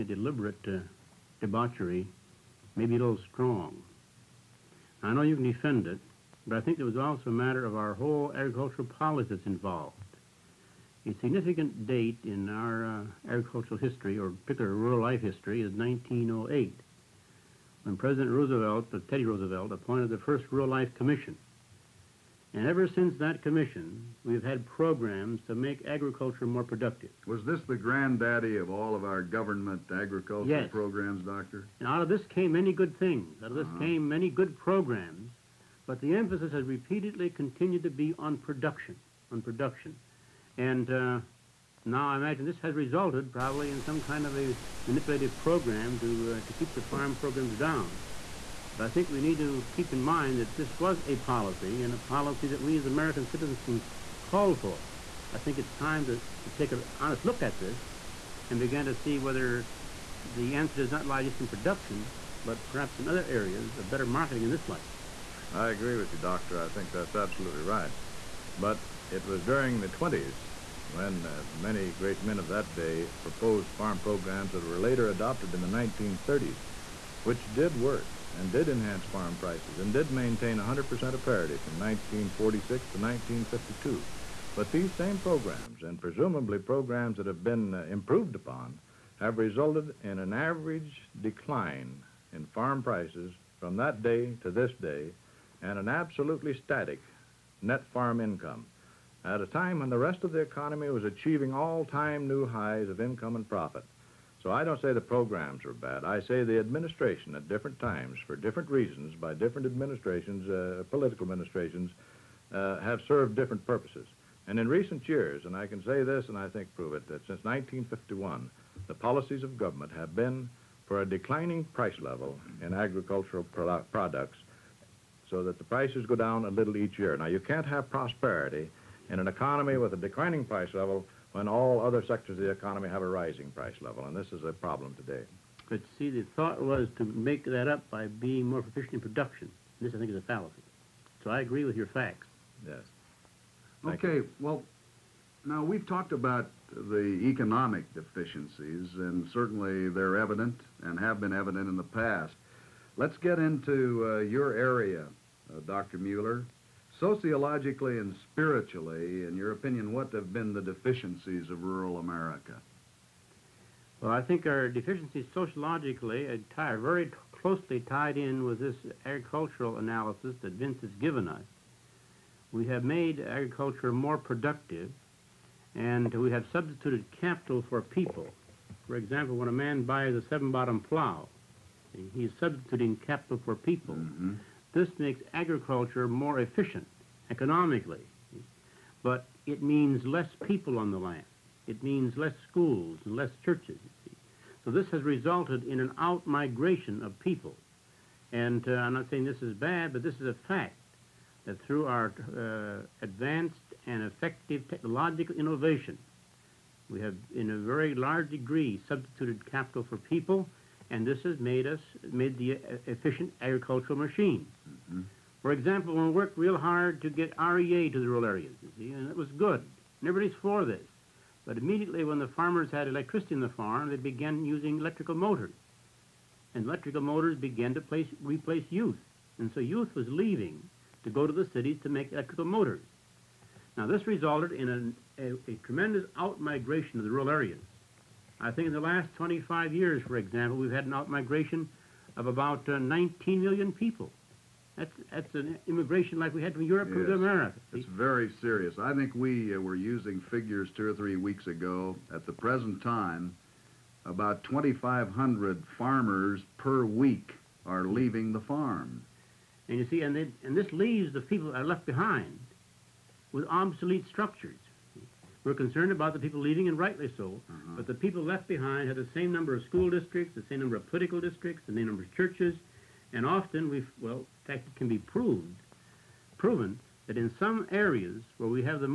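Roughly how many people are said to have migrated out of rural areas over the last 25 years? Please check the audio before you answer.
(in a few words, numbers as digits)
19 million.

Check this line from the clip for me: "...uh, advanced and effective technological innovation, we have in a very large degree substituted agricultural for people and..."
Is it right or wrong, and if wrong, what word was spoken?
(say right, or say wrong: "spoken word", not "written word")
wrong: "capital", not "agricultural".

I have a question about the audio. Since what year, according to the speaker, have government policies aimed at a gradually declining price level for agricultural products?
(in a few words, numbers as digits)
1951.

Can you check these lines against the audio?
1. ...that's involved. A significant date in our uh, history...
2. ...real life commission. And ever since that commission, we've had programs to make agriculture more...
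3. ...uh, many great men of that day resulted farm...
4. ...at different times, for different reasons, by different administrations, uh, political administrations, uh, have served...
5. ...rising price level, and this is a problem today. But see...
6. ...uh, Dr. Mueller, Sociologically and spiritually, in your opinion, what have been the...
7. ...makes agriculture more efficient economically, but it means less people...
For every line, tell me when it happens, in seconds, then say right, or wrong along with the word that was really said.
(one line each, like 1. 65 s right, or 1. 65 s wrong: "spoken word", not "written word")
1. 9 s right
2. 20 s right
3. 71 s wrong: "proposed", not "resulted"
4. 107 s right
5. 133 s right
6. 155 s right
7. 184 s right.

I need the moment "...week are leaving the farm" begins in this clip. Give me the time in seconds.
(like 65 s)
256 s.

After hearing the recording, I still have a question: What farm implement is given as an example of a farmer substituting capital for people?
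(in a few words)
seven-bottom plow.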